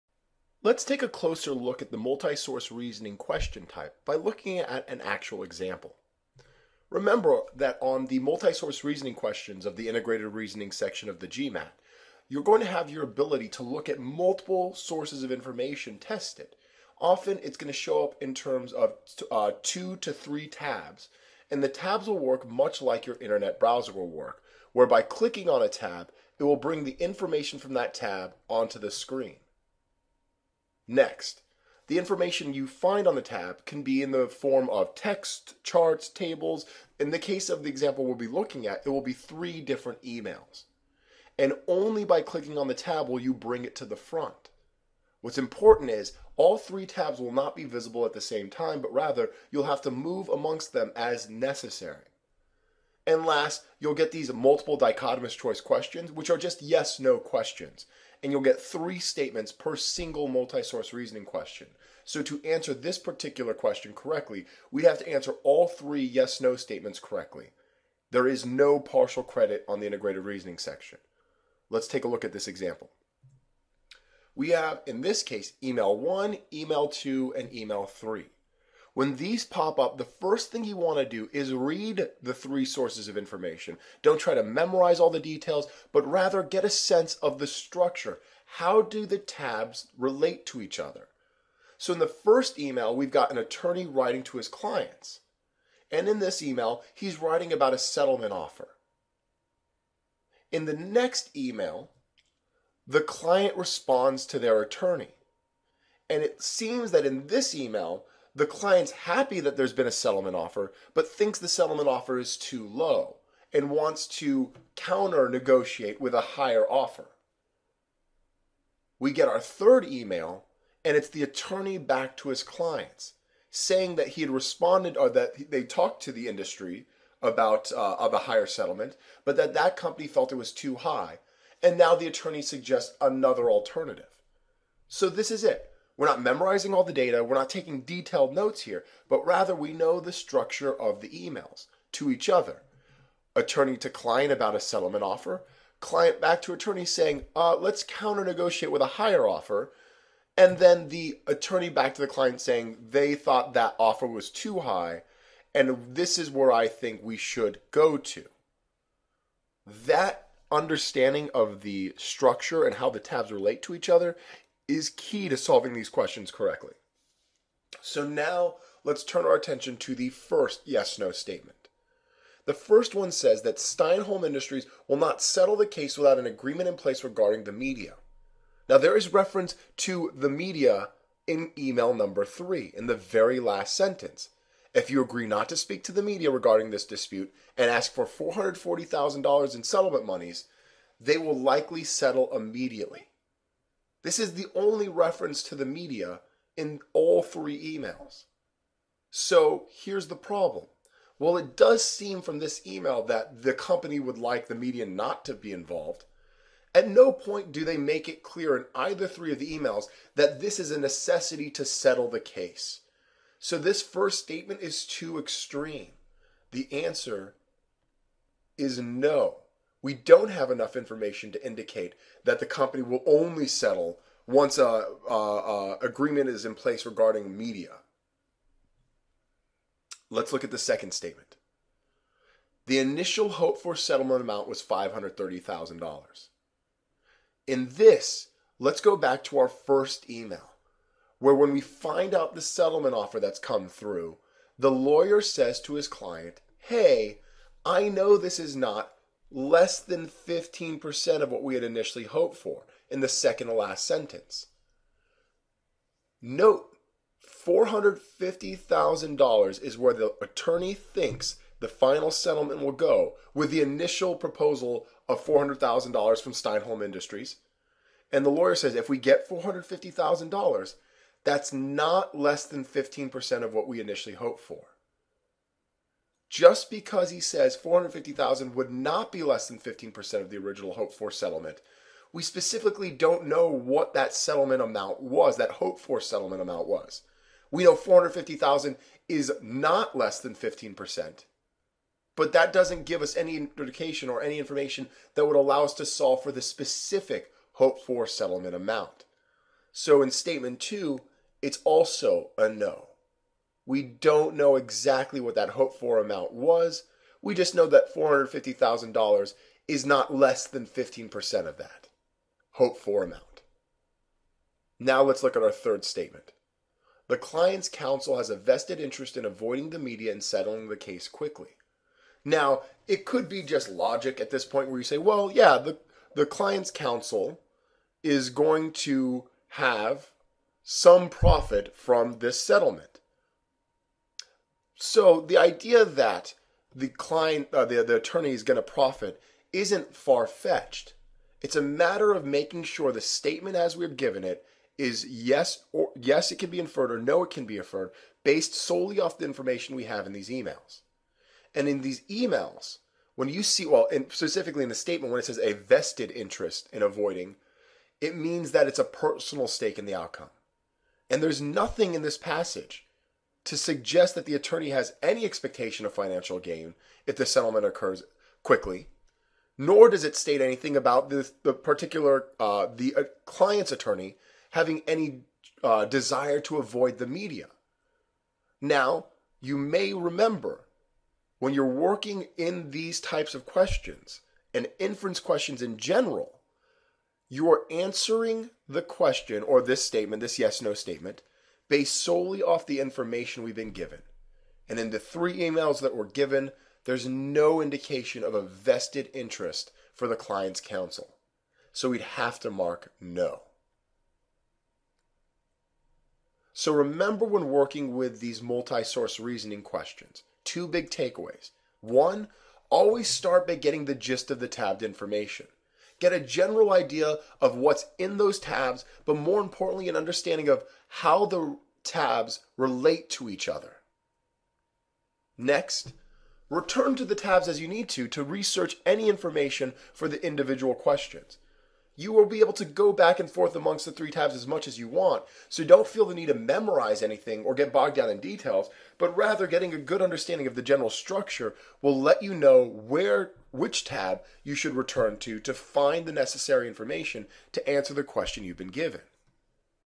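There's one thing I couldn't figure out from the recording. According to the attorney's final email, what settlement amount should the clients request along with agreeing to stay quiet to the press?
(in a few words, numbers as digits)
$440,000.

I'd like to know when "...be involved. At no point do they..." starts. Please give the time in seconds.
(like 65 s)
205 s.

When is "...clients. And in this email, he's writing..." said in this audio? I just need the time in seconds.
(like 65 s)
94 s.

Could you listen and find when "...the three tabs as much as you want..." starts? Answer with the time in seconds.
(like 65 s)
433 s.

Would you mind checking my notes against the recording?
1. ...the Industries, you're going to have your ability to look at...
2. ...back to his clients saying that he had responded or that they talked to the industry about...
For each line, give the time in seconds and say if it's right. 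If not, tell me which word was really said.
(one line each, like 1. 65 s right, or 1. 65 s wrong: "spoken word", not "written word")
1. 11 s wrong: "GMAT", not "Industries"
2. 121 s right.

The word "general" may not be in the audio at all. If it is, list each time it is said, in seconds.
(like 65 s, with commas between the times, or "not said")
385 s, 416 s, 440 s.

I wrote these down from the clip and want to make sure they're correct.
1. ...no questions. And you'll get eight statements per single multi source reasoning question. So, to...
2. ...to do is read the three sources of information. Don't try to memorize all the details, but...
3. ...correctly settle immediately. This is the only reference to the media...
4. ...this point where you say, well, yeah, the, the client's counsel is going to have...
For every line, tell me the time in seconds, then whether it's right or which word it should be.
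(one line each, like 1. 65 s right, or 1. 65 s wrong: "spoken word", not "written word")
1. 56 s wrong: "three", not "eight"
2. 80 s right
3. 191 s wrong: "likely", not "correctly"
4. 324 s right.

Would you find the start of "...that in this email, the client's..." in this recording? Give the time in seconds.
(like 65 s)
106 s.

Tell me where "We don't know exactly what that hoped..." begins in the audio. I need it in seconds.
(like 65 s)
303 s.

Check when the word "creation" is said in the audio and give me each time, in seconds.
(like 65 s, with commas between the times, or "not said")
not said.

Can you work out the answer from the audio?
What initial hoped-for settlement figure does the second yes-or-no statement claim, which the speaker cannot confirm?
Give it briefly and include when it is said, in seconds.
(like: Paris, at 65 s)
$530,000, at 234 s.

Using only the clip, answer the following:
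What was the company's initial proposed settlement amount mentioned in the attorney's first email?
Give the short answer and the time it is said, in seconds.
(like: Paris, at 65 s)
$400,000, at 265 s.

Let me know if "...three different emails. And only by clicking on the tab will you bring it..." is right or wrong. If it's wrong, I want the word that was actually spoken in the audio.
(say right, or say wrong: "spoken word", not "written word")
right.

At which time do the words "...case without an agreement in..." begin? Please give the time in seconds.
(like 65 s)
175 s.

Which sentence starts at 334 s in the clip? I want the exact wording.
So the idea that the client, uh, the, the attorney is going to profit isn't far fetched.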